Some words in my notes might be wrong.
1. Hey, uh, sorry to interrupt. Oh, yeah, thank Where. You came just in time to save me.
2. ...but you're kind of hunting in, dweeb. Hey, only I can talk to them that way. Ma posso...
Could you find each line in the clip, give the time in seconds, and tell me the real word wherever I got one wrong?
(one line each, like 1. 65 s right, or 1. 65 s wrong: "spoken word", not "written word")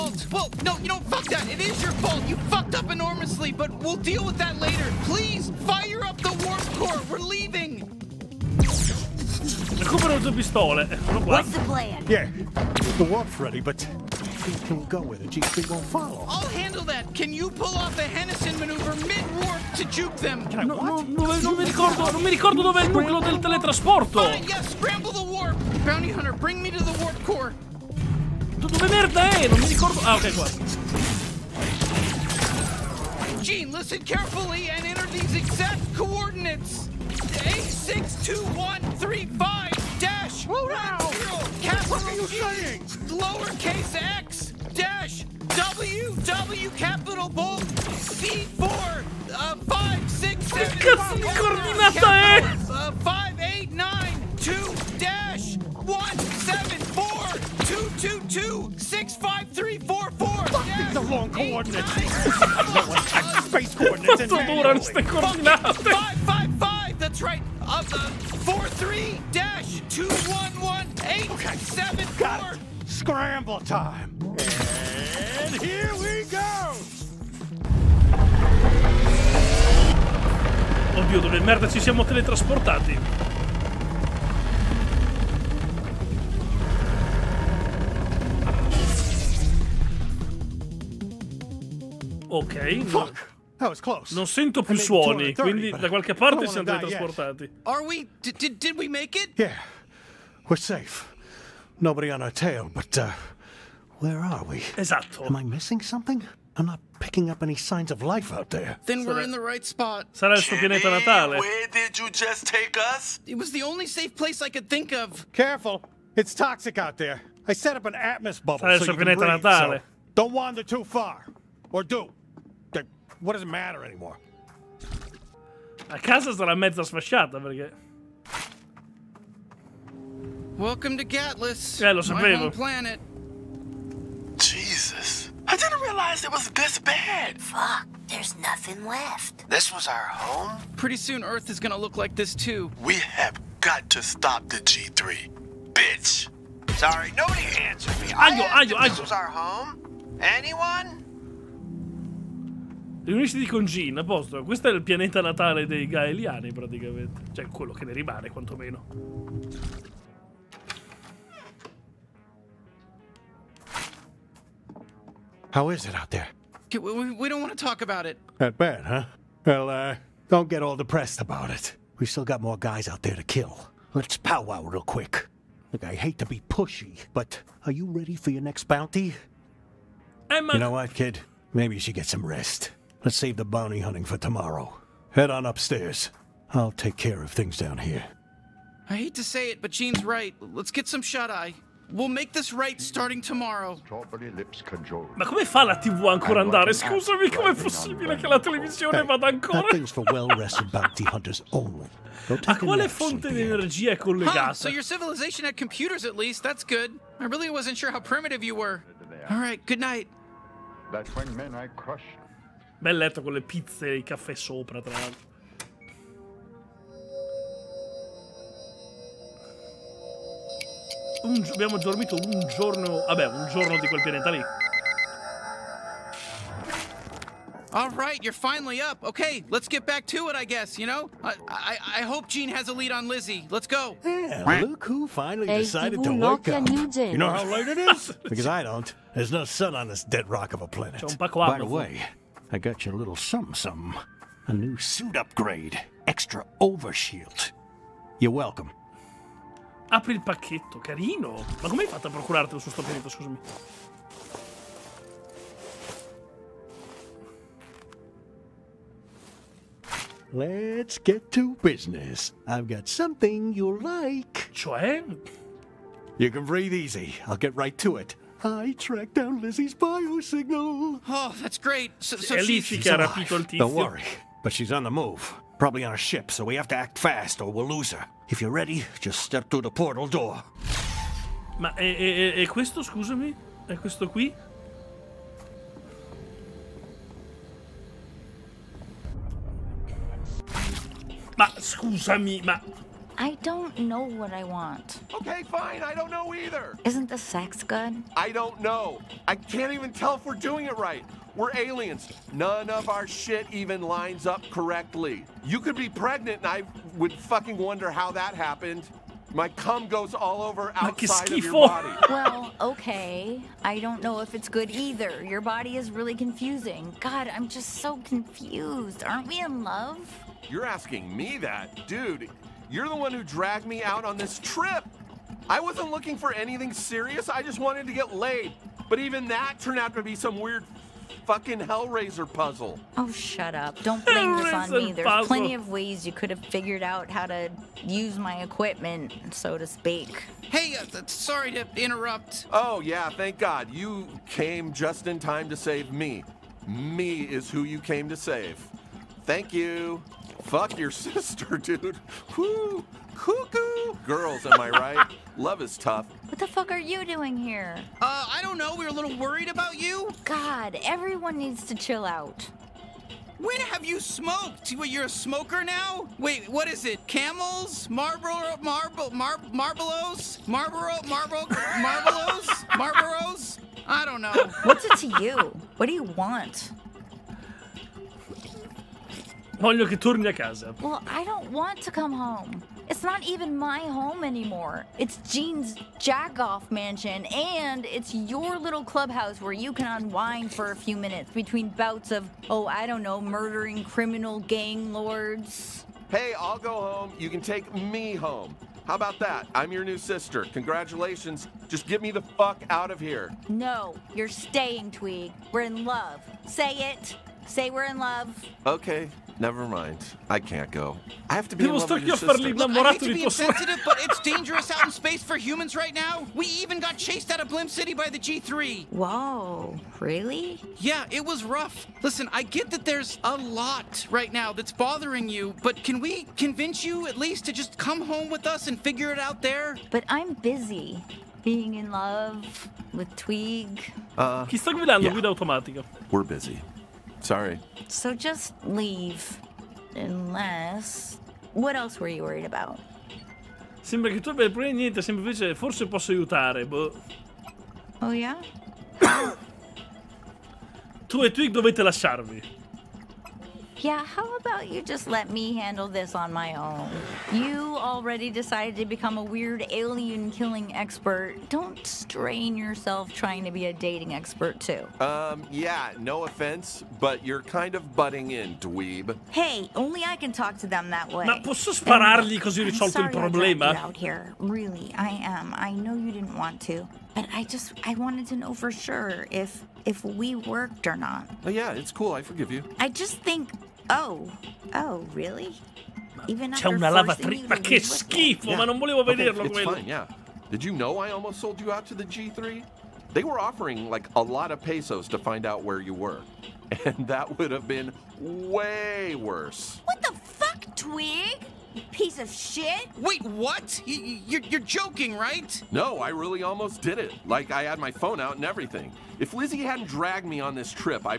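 1. 340 s wrong: "God", not "Where"
2. 466 s wrong: "butting", not "hunting".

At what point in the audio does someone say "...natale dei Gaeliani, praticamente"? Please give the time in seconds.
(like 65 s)
155 s.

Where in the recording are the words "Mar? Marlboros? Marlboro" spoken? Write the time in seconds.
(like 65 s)
369 s.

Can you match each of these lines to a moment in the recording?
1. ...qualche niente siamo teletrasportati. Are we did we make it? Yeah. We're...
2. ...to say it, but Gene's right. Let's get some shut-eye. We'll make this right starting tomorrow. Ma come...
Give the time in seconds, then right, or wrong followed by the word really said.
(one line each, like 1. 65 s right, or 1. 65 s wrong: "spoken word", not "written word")
1. 95 s wrong: "parte", not "niente"
2. 189 s right.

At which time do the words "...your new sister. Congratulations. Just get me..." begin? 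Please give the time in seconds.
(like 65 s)
399 s.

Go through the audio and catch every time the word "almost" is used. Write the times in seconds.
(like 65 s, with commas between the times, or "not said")
491 s, 506 s.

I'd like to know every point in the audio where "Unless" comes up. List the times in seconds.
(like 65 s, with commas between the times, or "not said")
439 s.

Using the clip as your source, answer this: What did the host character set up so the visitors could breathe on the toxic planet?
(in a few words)
An atmos bubble.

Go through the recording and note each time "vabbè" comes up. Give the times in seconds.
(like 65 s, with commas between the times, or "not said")
223 s.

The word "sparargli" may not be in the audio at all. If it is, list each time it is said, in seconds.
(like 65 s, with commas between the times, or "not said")
471 s.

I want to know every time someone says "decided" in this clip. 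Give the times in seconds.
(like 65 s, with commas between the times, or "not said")
235 s, 458 s.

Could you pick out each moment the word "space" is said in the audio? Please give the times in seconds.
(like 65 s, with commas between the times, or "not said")
63 s, 414 s.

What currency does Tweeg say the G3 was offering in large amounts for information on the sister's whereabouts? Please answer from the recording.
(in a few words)
Pesos.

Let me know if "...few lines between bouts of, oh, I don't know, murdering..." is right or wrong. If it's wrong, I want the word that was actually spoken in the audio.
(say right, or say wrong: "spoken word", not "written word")
wrong: "minutes", not "lines".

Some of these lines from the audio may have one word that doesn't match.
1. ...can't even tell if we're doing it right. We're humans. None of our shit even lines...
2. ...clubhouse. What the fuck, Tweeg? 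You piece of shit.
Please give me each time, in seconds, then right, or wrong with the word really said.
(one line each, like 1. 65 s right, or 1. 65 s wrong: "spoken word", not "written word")
1. 299 s wrong: "aliens", not "humans"
2. 499 s wrong: "worse", not "clubhouse".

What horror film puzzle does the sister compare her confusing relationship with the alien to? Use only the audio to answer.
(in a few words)
Hellraiser.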